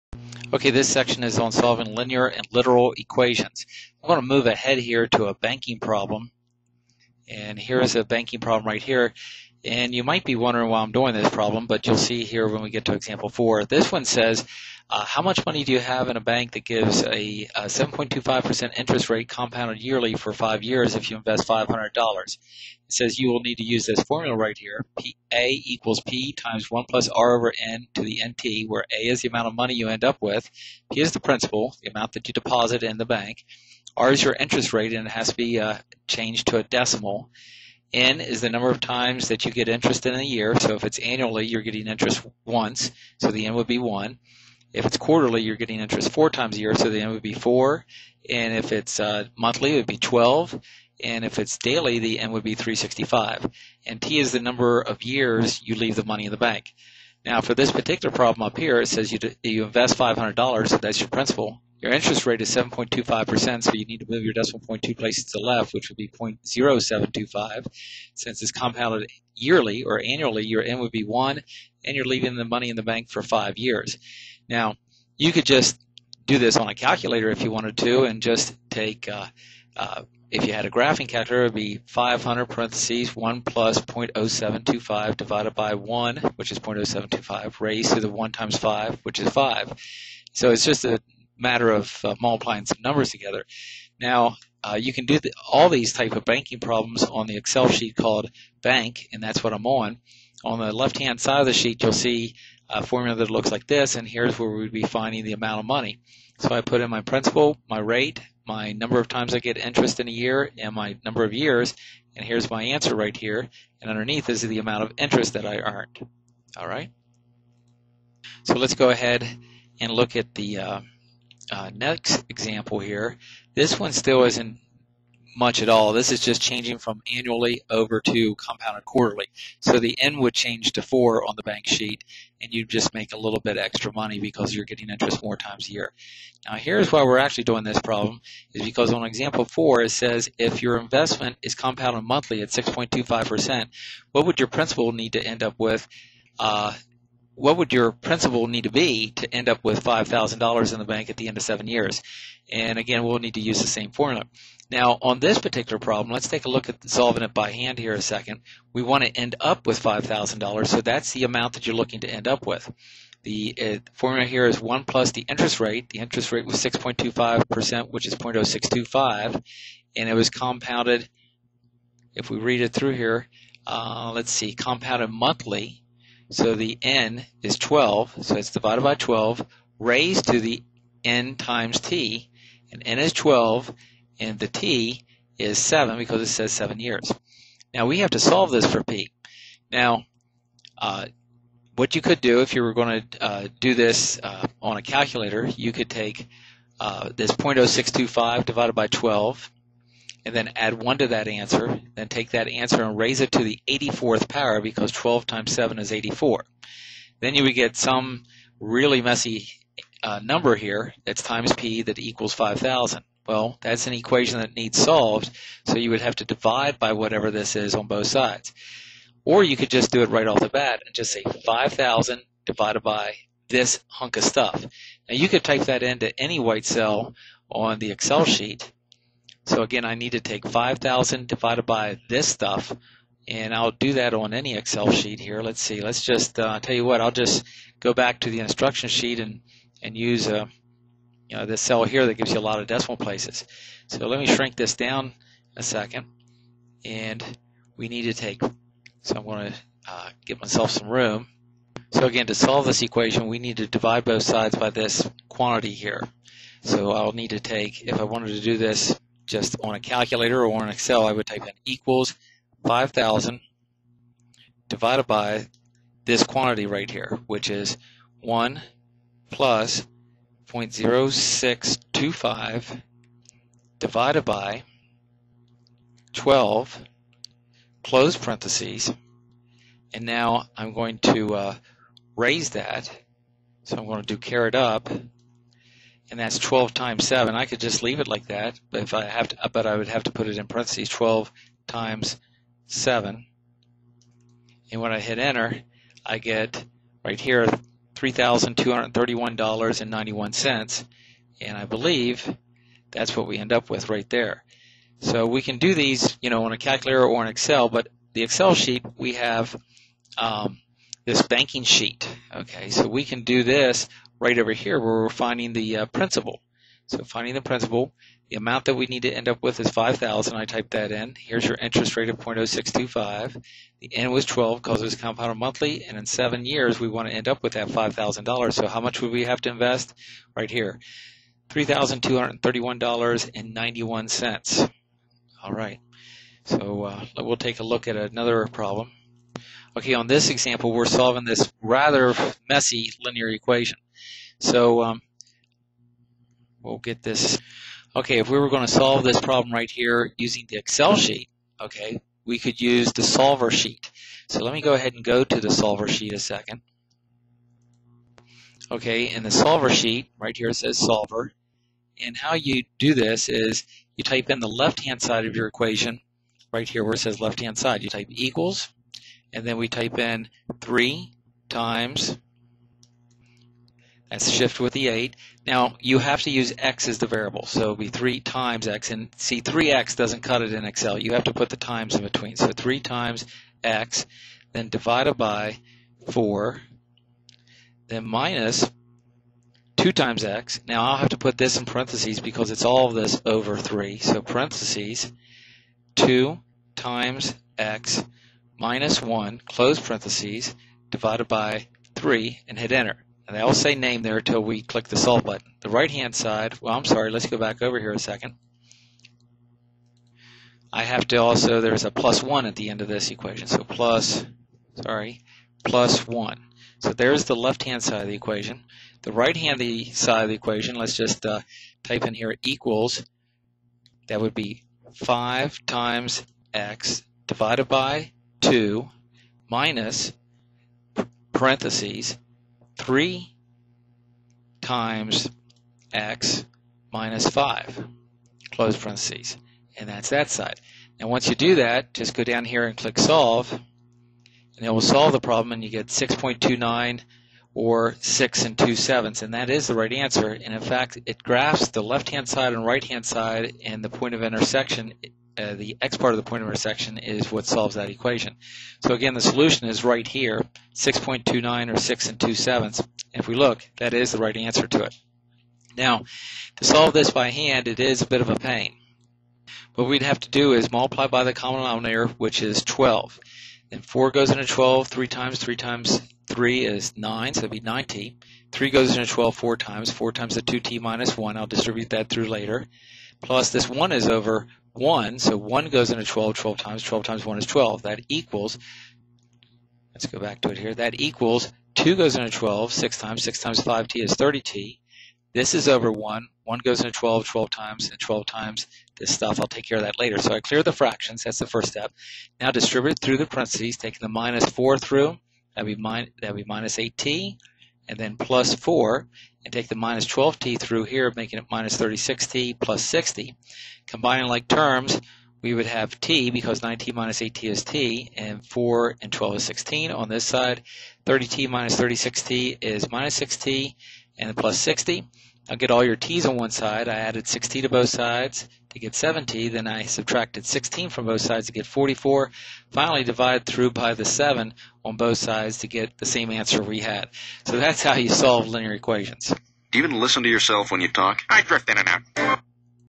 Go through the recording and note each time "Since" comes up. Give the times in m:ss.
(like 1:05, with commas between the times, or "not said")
1:08.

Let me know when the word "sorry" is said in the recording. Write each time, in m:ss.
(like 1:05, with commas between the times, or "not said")
6:46, 6:54.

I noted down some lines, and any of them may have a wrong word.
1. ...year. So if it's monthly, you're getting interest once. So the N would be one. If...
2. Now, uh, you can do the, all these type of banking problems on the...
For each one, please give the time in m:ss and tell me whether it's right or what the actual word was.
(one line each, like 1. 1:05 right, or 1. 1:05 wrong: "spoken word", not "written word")
1. 0:40 wrong: "annually", not "monthly"
2. 1:33 right.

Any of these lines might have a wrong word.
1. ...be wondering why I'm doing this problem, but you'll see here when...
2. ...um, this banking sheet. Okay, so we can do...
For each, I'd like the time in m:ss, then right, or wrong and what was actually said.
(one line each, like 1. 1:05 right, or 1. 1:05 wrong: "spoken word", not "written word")
1. 0:10 right
2. 5:10 right.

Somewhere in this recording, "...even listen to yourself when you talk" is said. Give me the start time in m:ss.
8:59.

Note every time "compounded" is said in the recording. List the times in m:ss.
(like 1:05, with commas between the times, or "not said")
0:19, 1:08, 2:08, 2:21, 2:50, 2:54, 5:24.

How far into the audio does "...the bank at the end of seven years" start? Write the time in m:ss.
2:30.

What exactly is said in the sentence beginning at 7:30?
And in fact, it graphs the left-hand side and right-hand side and the point of intersection.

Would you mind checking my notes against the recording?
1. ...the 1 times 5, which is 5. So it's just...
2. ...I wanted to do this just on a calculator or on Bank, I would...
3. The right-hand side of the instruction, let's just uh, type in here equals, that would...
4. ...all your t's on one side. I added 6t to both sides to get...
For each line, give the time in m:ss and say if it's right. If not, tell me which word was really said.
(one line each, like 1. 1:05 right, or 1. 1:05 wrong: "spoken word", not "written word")
1. 1:28 right
2. 4:17 wrong: "Excel", not "Bank"
3. 6:59 wrong: "equation", not "instruction"
4. 8:45 right.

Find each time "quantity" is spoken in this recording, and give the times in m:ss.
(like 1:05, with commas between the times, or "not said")
4:15, 4:26.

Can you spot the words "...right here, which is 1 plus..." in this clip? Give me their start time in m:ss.
4:26.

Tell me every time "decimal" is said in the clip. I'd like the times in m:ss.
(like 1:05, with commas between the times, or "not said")
0:36, 1:04, 4:02.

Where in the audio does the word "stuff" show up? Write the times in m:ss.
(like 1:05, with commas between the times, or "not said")
3:44, 3:52, 8:19.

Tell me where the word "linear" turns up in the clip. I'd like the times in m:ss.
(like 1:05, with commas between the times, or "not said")
0:01, 5:43, 8:58.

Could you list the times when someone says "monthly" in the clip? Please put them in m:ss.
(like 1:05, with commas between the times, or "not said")
0:49, 2:22, 2:55, 5:25.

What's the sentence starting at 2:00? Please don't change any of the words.
Uh, uh, next example here, this one still isn't much at all.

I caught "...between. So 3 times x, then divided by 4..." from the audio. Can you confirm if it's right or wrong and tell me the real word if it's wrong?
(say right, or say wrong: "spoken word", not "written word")
right.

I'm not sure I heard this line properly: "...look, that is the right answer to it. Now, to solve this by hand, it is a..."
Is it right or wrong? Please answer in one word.
right.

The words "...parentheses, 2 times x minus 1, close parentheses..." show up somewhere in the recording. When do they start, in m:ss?
6:34.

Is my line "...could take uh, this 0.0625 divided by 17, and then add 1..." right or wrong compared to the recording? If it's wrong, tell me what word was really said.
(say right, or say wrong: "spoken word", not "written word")
wrong: "12", not "17".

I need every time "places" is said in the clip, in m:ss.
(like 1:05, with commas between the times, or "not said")
1:04, 4:02.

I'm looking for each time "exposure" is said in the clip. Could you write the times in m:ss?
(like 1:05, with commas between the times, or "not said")
not said.